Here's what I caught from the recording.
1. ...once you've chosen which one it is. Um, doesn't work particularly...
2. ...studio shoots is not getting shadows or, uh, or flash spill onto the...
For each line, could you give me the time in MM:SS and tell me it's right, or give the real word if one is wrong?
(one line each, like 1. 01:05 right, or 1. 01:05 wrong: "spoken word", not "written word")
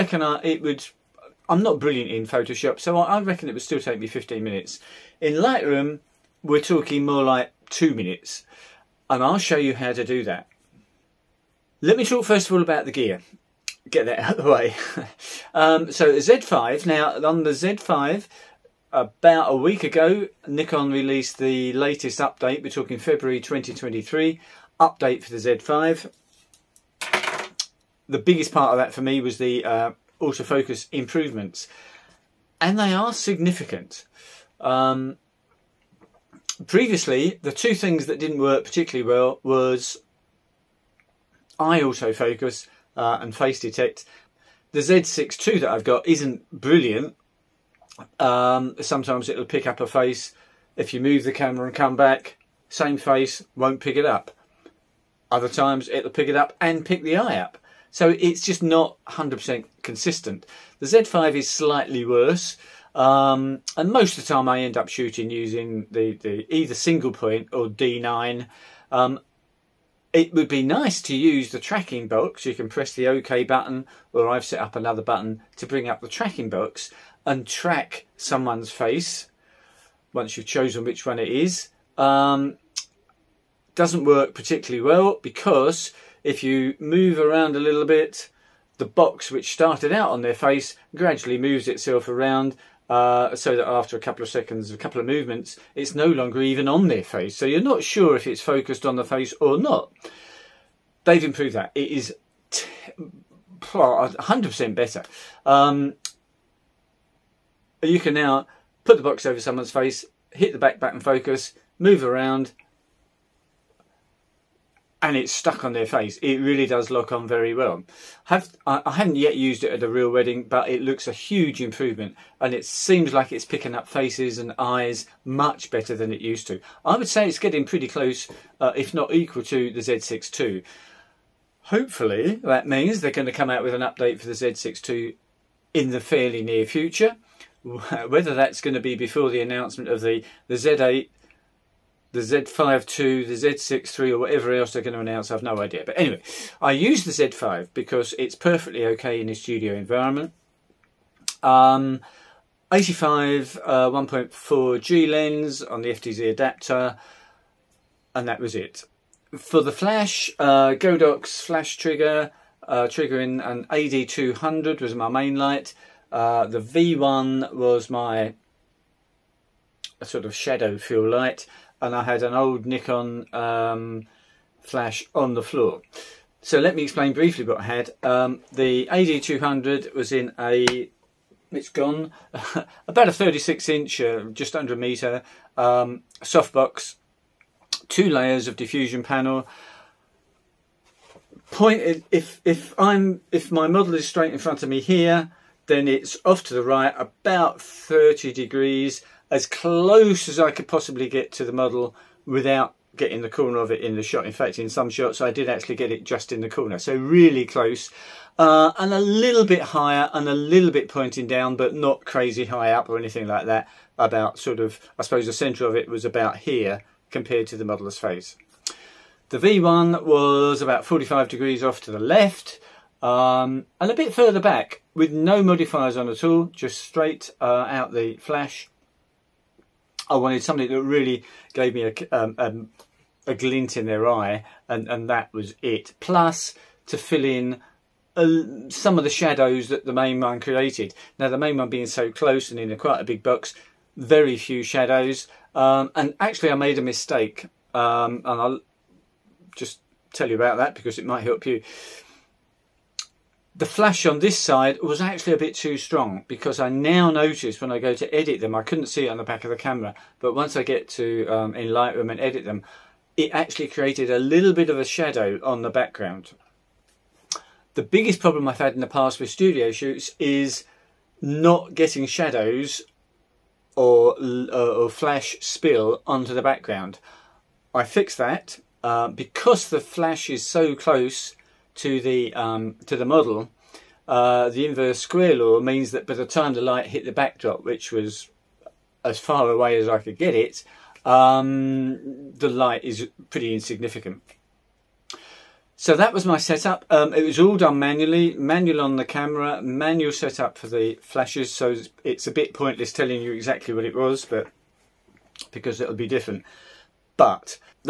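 1. 01:20 right
2. 04:29 right.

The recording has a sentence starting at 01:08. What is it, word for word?
Um, it would be nice to use the tracking box.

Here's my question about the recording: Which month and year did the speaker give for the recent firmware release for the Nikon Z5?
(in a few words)
February 2023.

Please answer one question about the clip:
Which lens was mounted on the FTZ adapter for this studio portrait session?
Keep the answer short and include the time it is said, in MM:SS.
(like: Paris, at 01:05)
85mm 1.4G, at 02:32.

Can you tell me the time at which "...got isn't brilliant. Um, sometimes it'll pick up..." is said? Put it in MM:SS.
00:45.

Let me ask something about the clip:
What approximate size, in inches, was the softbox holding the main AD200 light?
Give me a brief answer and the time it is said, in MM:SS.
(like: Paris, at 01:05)
36 inch, at 03:03.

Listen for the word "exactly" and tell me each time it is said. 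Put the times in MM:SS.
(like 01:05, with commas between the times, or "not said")
05:03.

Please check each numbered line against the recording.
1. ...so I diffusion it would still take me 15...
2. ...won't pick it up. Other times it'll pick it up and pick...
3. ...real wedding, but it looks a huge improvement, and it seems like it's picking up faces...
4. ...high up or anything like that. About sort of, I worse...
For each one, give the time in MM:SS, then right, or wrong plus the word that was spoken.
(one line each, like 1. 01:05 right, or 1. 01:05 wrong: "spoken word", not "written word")
1. 00:02 wrong: "reckon", not "diffusion"
2. 00:53 right
3. 01:59 right
4. 03:32 wrong: "suppose", not "worse".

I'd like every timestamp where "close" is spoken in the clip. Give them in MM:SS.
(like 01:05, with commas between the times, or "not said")
02:07, 03:19, 03:27, 04:02, 04:40.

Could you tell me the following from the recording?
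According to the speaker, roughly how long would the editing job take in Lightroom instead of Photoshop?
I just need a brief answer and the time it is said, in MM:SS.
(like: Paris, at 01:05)
2 minutes, at 00:07.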